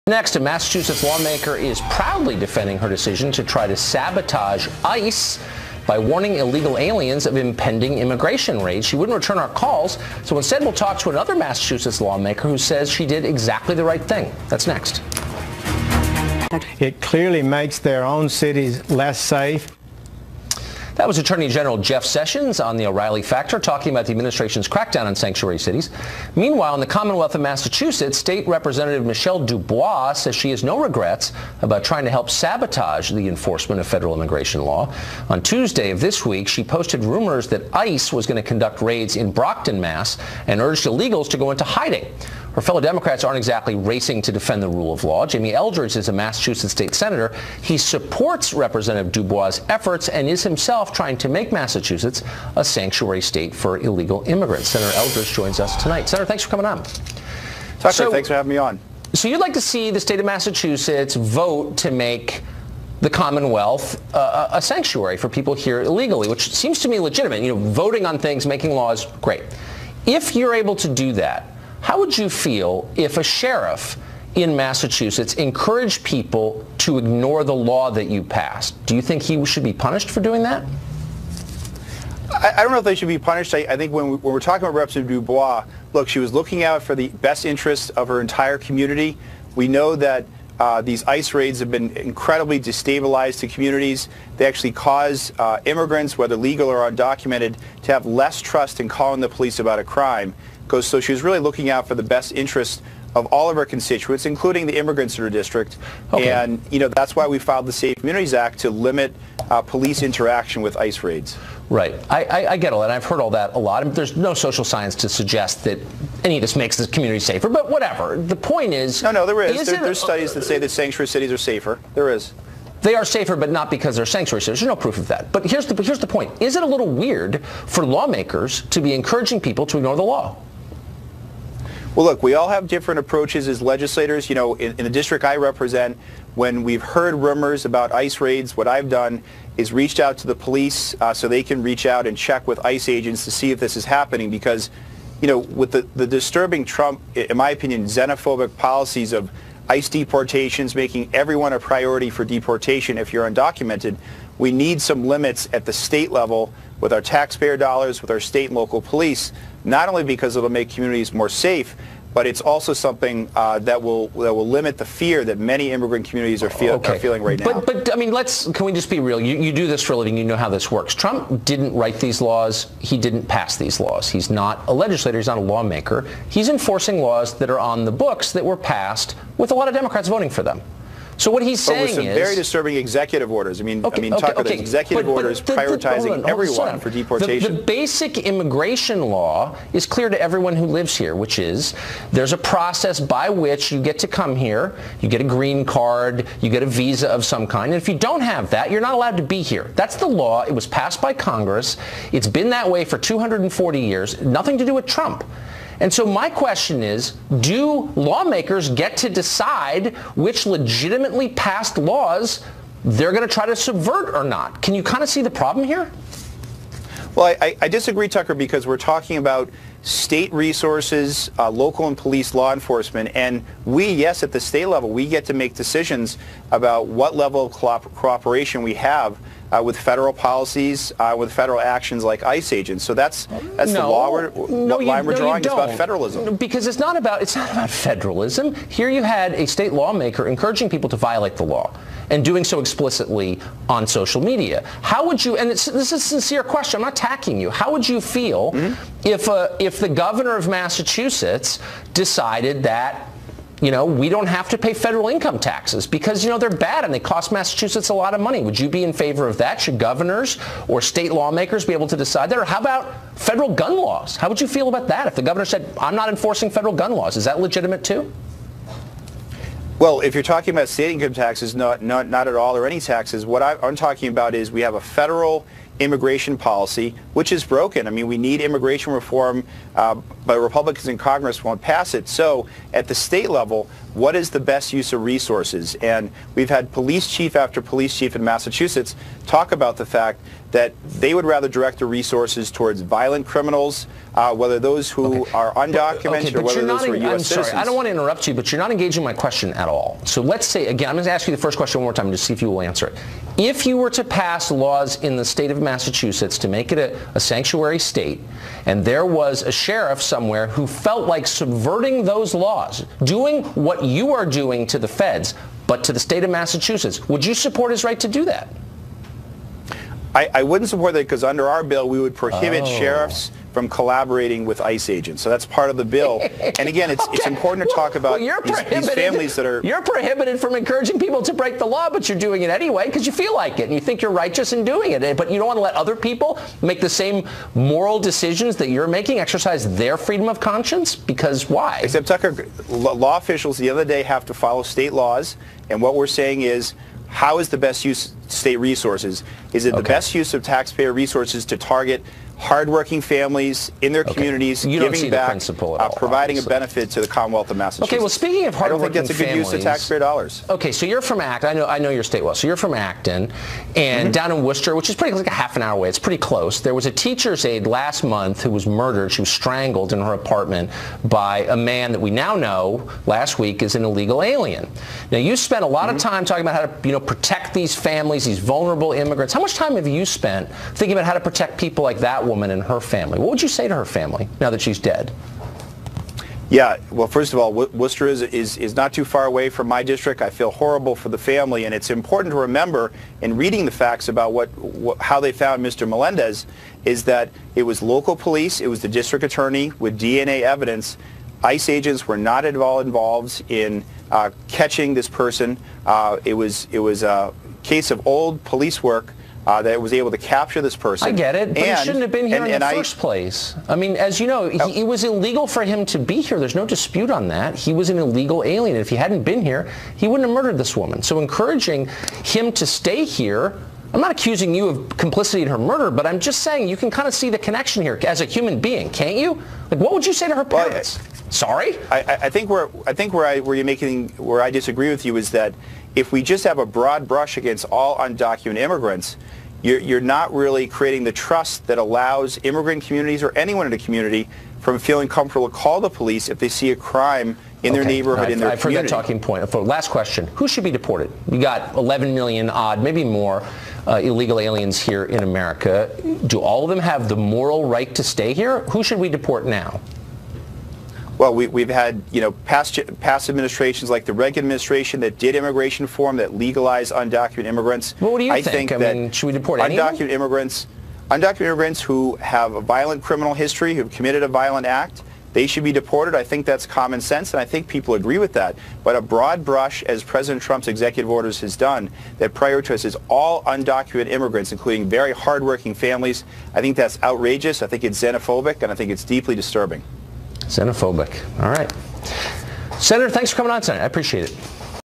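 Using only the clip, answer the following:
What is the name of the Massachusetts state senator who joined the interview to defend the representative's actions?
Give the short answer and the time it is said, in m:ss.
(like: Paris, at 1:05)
Jamie Eldridge, at 0:45.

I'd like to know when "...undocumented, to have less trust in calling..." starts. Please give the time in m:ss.
1:36.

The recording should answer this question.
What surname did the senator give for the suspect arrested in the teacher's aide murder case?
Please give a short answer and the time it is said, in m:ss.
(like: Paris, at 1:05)
Melendez, at 6:35.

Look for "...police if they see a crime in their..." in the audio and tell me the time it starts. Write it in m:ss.
7:25.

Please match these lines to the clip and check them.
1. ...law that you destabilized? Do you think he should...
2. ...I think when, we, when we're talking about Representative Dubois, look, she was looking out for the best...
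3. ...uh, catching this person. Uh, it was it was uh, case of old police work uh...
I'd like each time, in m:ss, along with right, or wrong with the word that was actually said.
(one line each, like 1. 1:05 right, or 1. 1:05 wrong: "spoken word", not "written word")
1. 1:17 wrong: "passed", not "destabilized"
2. 1:23 right
3. 6:44 right.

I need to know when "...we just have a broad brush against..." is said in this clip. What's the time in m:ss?
7:16.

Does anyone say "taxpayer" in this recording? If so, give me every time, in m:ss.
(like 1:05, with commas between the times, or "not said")
2:37, 5:50, 5:59.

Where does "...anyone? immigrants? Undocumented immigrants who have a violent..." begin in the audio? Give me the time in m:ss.
7:49.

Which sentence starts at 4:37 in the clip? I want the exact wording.
I mean, we need immigration reform, uh, but Republicans in Congress won't pass it.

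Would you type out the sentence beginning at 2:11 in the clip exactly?
Well, look, we all have different approaches as legislators.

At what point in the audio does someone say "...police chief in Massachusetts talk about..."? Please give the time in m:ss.
4:47.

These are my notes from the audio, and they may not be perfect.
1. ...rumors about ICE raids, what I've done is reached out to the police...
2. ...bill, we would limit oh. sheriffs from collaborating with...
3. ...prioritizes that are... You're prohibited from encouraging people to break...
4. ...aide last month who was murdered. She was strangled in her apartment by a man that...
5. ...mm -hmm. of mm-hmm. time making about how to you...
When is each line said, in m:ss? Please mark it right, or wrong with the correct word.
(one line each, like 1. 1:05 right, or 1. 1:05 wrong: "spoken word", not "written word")
1. 2:17 right
2. 5:21 wrong: "prohibit", not "limit"
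3. 5:28 wrong: "families", not "prioritizes"
4. 6:07 right
5. 6:15 wrong: "talking", not "making".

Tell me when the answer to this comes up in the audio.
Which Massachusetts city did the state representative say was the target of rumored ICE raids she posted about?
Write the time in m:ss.
0:39.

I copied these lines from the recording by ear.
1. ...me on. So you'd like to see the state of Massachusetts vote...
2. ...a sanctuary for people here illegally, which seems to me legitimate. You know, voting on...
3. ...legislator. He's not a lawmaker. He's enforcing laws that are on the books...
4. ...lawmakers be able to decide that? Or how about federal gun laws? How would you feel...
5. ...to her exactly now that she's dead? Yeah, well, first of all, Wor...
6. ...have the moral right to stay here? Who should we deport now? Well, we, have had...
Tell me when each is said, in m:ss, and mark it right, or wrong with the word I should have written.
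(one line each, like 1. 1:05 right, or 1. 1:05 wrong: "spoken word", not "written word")
1. 0:58 right
2. 1:04 right
3. 2:54 right
4. 4:21 right
5. 6:23 wrong: "family", not "exactly"
6. 7:36 right.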